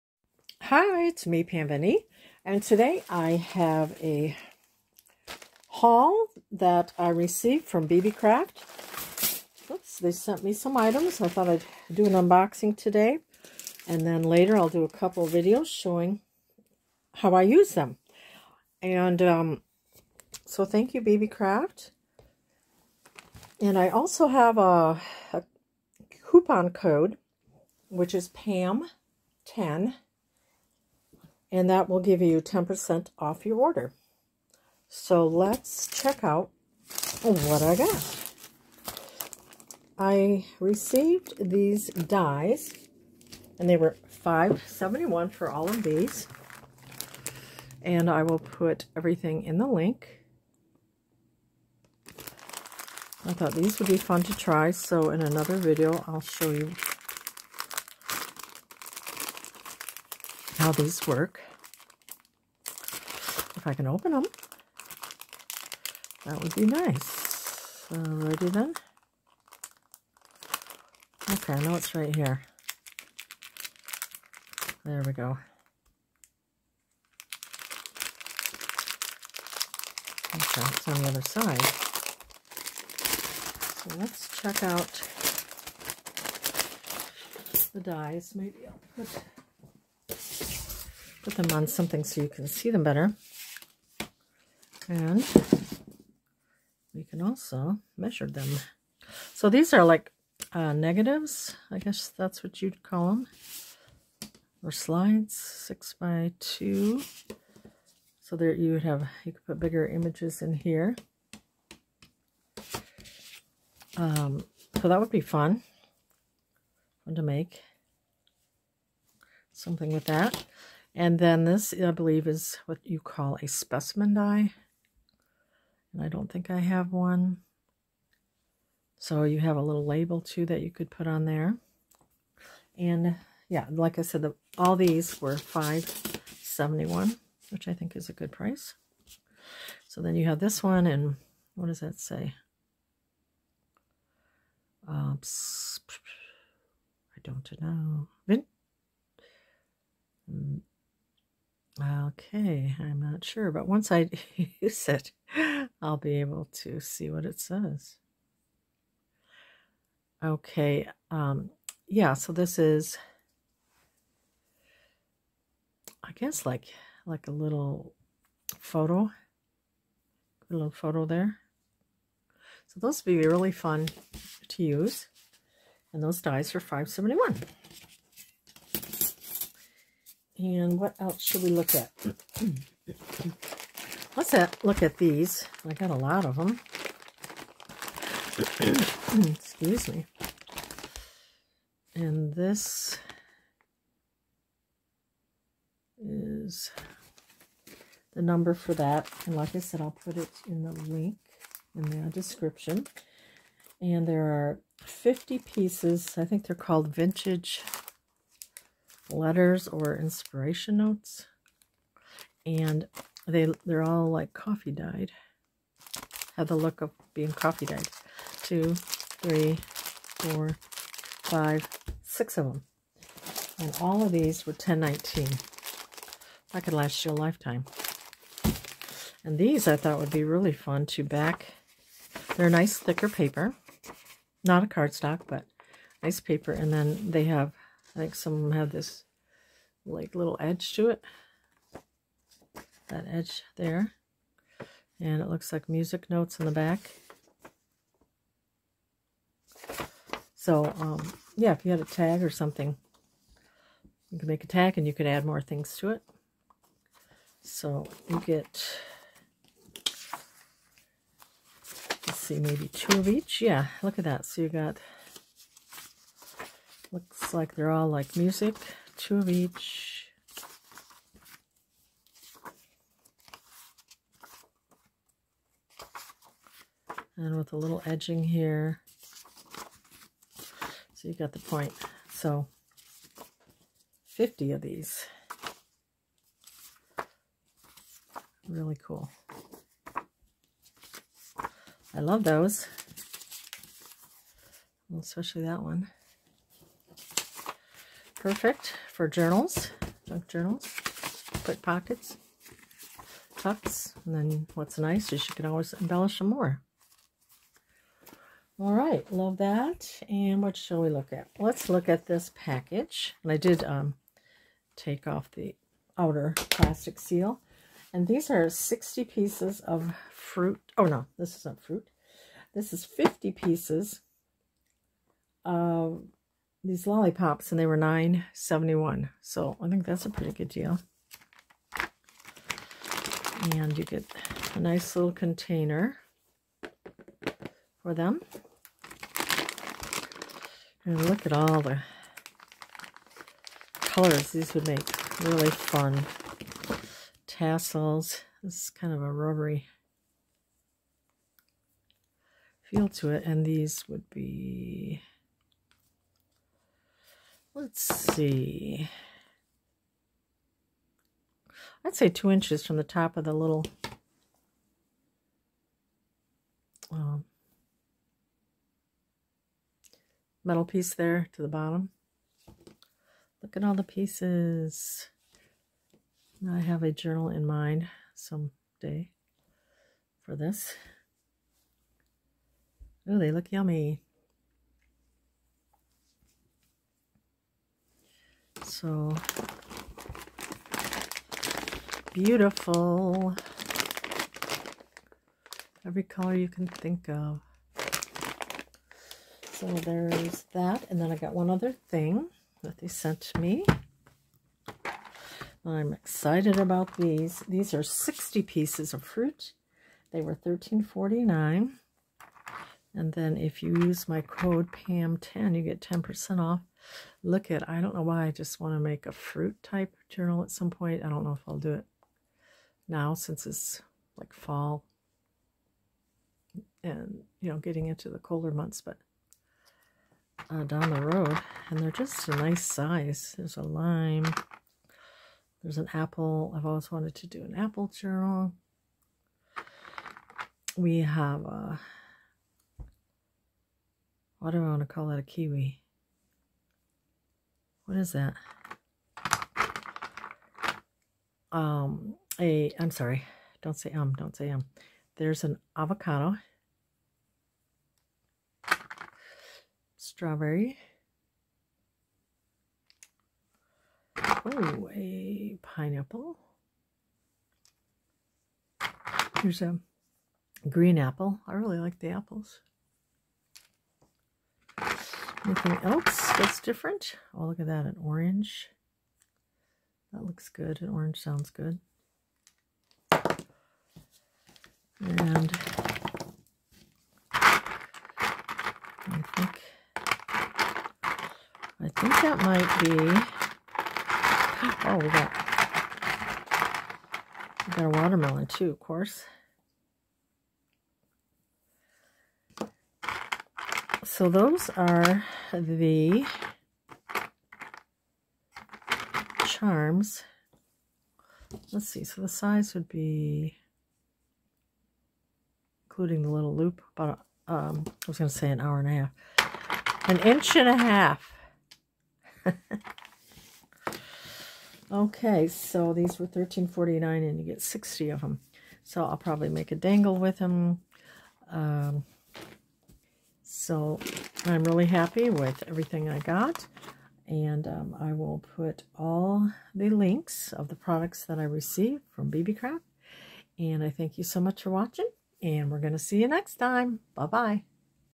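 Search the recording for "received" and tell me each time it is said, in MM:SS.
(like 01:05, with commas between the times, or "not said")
00:07, 00:40, 09:01.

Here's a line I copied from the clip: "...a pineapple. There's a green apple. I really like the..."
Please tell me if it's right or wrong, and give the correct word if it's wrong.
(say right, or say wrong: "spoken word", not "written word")
right.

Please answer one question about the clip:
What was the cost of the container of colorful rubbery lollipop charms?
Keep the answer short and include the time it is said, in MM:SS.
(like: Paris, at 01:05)
$9.71, at 05:27.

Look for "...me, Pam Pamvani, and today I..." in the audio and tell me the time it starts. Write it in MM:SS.
00:01.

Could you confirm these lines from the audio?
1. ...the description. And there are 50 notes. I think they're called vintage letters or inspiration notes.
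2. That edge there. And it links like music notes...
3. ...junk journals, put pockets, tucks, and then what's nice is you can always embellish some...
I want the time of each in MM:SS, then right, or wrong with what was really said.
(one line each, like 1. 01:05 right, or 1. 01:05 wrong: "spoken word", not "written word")
1. 03:22 wrong: "pieces", not "notes"
2. 04:02 wrong: "looks", not "links"
3. 05:00 right.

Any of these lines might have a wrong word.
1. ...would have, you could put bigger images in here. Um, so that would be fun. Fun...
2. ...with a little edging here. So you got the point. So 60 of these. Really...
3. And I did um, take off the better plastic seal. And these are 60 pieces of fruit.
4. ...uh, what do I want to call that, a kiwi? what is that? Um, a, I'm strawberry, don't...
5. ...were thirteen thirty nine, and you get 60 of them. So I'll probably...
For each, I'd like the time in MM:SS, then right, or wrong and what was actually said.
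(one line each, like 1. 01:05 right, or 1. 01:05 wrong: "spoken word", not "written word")
1. 01:48 right
2. 04:37 wrong: "50", not "60"
3. 05:13 wrong: "outer", not "better"
4. 07:22 wrong: "sorry", not "strawberry"
5. 08:46 wrong: "forty", not "thirty".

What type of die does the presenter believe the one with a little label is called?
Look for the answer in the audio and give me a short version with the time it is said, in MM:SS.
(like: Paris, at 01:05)
specimen die, at 02:03.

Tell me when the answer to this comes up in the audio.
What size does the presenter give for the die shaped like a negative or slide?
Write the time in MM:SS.
01:45.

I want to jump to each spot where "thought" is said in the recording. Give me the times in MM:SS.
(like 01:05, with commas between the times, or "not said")
00:11, 00:53, 03:49.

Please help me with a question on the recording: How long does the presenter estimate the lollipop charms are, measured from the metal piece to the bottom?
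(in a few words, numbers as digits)
2 inches.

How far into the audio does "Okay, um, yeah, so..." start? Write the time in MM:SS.
02:40.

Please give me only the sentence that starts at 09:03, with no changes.
And I thank you so much for watching.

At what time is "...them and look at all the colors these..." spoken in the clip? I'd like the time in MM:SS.
05:37.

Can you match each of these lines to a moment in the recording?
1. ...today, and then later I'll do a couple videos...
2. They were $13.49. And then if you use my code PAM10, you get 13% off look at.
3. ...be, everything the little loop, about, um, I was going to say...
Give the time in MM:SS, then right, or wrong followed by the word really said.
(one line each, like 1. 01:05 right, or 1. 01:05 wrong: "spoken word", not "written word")
1. 00:12 right
2. 06:50 wrong: "10", not "13"
3. 08:32 wrong: "including", not "everything".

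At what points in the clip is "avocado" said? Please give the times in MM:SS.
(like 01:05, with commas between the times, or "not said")
07:35.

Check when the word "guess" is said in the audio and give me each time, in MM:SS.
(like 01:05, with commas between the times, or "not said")
01:41, 02:46.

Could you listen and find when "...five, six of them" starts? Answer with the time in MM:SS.
03:41.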